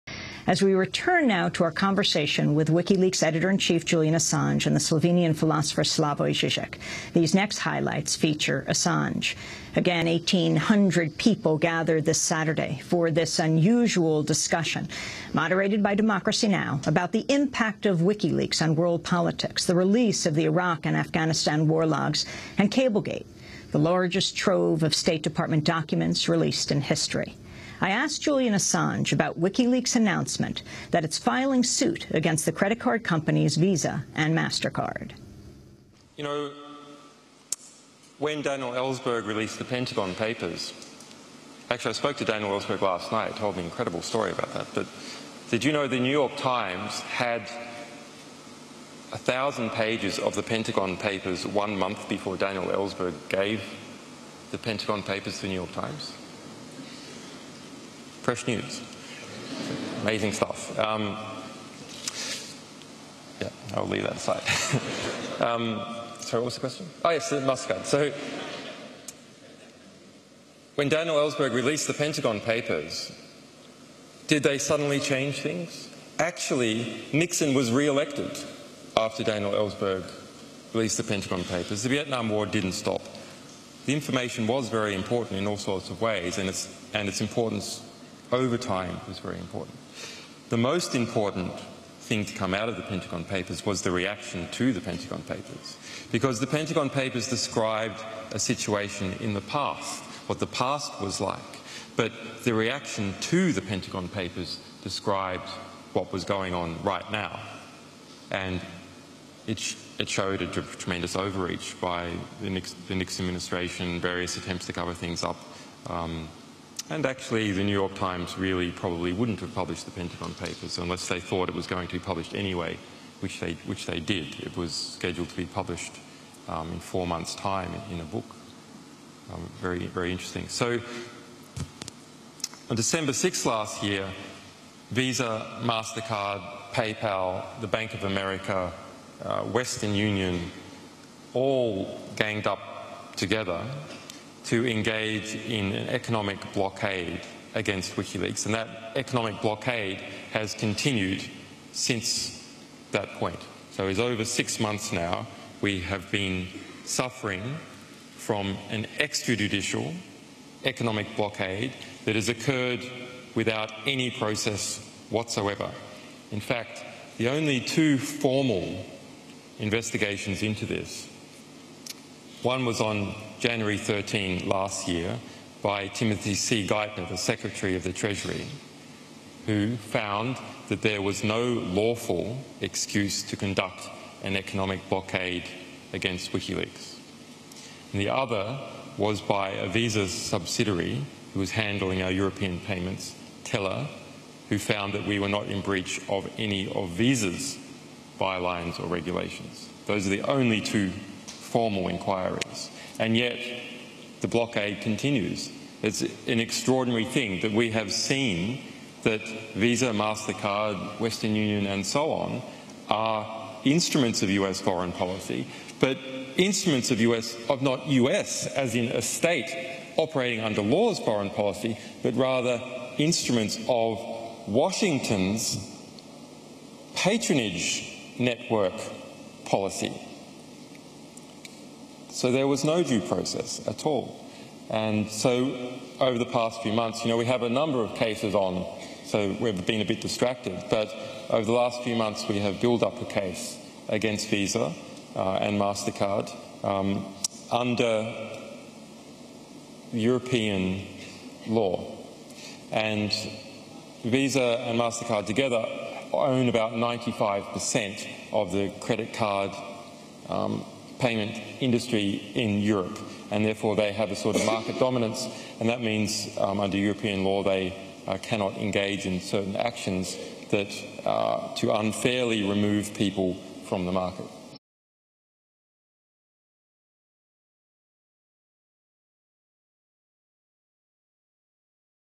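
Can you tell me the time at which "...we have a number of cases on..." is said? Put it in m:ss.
3:57.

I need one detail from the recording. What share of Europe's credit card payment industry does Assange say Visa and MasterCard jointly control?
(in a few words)
95%.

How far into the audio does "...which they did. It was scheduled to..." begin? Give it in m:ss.
2:03.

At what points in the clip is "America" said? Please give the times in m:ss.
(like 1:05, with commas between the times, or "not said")
2:18.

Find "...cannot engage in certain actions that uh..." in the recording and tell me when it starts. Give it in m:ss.
4:28.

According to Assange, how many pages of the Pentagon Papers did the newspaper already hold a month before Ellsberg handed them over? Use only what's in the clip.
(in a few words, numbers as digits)
1,000 pages.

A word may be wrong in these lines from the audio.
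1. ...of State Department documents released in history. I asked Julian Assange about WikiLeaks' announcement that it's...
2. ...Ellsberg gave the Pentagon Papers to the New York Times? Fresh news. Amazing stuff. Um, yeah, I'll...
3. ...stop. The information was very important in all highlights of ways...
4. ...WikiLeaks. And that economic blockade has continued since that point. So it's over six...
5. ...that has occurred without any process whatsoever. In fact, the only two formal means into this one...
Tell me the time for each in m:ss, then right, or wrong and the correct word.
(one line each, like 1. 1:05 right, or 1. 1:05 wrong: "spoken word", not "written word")
1. 0:24 right
2. 0:52 right
3. 1:22 wrong: "sorts", not "highlights"
4. 2:27 right
5. 2:42 wrong: "investigations", not "means".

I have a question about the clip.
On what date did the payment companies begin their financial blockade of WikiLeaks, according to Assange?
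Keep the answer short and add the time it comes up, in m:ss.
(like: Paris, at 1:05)
December 6th, at 2:12.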